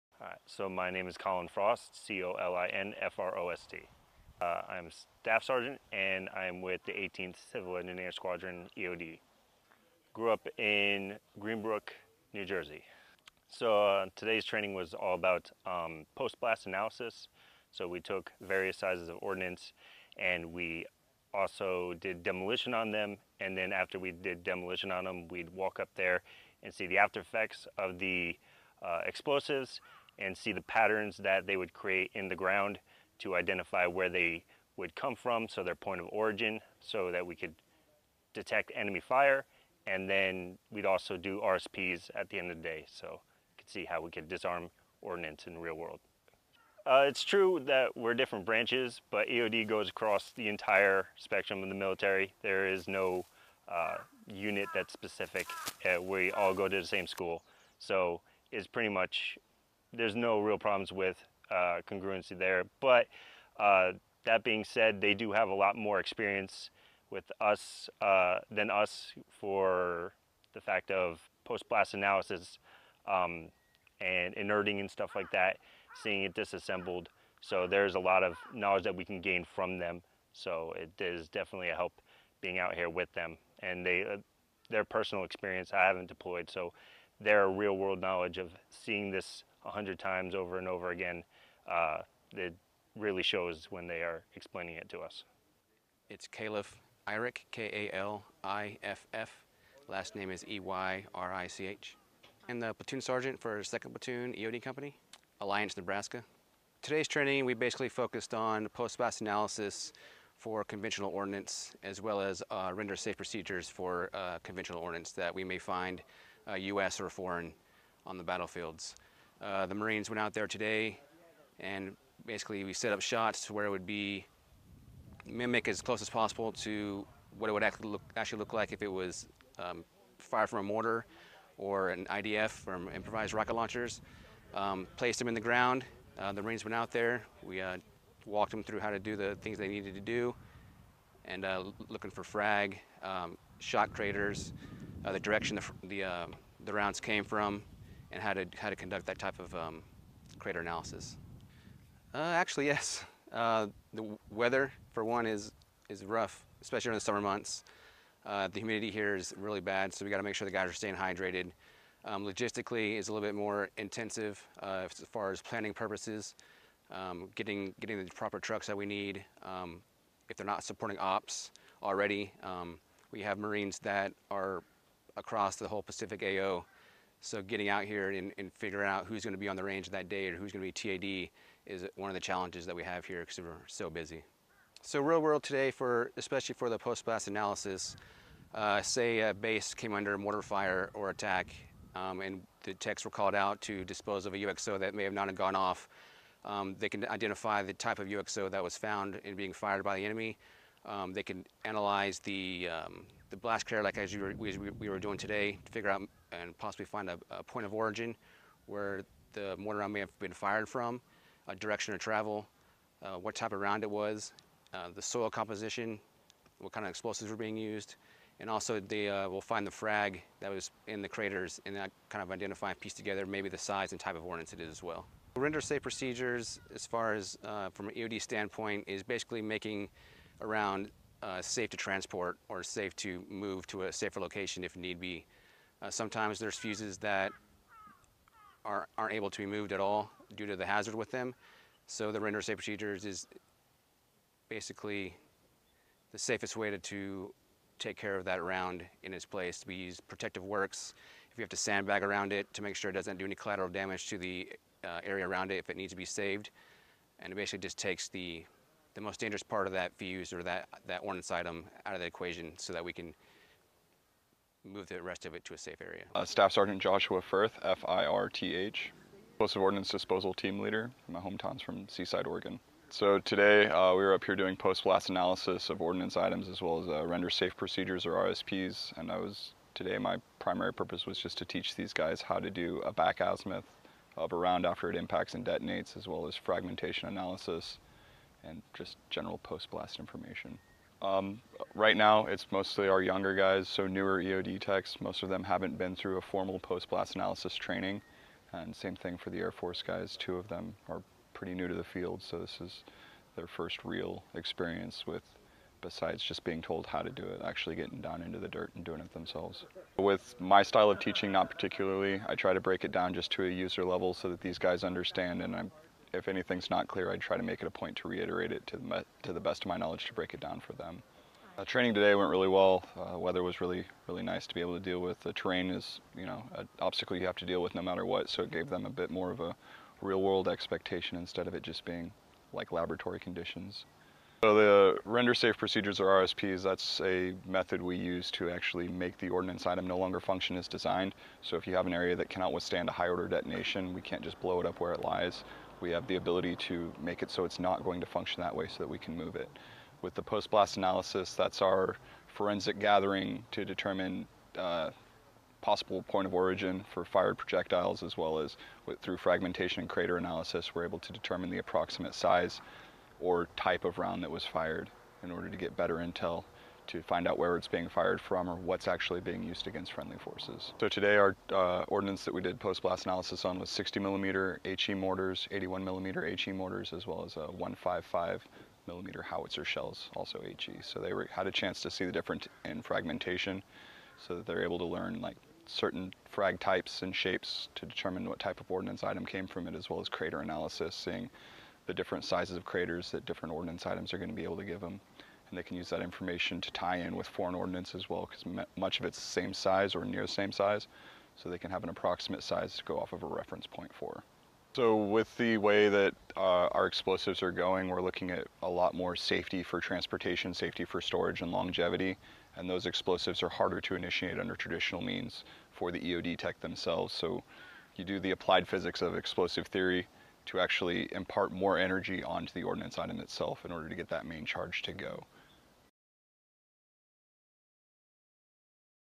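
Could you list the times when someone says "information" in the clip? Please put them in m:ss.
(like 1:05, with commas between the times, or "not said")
4:49, 6:36.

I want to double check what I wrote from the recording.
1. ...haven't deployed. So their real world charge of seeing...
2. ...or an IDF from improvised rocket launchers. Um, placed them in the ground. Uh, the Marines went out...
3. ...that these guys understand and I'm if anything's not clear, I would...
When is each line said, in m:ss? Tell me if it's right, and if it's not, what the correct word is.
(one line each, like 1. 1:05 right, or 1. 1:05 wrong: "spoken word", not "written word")
1. 1:25 wrong: "knowledge", not "charge"
2. 2:11 right
3. 5:14 right.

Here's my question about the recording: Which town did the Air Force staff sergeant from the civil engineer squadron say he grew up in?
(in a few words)
Greenbrook, New Jersey.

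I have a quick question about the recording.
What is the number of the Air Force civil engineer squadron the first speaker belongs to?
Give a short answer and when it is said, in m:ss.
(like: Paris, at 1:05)
18th, at 0:06.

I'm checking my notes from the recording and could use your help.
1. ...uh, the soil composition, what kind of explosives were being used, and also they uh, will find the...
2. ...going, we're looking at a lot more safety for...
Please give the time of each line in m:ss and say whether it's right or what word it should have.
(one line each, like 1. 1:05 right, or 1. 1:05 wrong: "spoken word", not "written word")
1. 3:34 right
2. 6:47 right.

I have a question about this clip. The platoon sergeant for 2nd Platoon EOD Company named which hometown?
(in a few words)
Alliance, Nebraska.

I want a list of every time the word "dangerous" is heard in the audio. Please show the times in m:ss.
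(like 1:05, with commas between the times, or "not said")
4:19.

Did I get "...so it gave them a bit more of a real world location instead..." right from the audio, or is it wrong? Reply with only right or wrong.
wrong.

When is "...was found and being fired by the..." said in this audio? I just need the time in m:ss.
3:18.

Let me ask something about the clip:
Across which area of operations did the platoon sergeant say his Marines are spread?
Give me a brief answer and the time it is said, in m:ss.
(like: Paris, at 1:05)
Pacific, at 2:55.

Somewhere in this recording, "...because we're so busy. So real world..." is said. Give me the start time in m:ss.
3:03.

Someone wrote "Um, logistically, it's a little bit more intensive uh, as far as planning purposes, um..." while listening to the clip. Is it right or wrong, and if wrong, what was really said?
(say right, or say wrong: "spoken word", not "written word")
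right.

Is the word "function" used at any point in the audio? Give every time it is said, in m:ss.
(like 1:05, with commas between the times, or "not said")
5:40, 5:48.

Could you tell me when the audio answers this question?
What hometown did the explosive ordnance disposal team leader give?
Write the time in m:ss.
4:31.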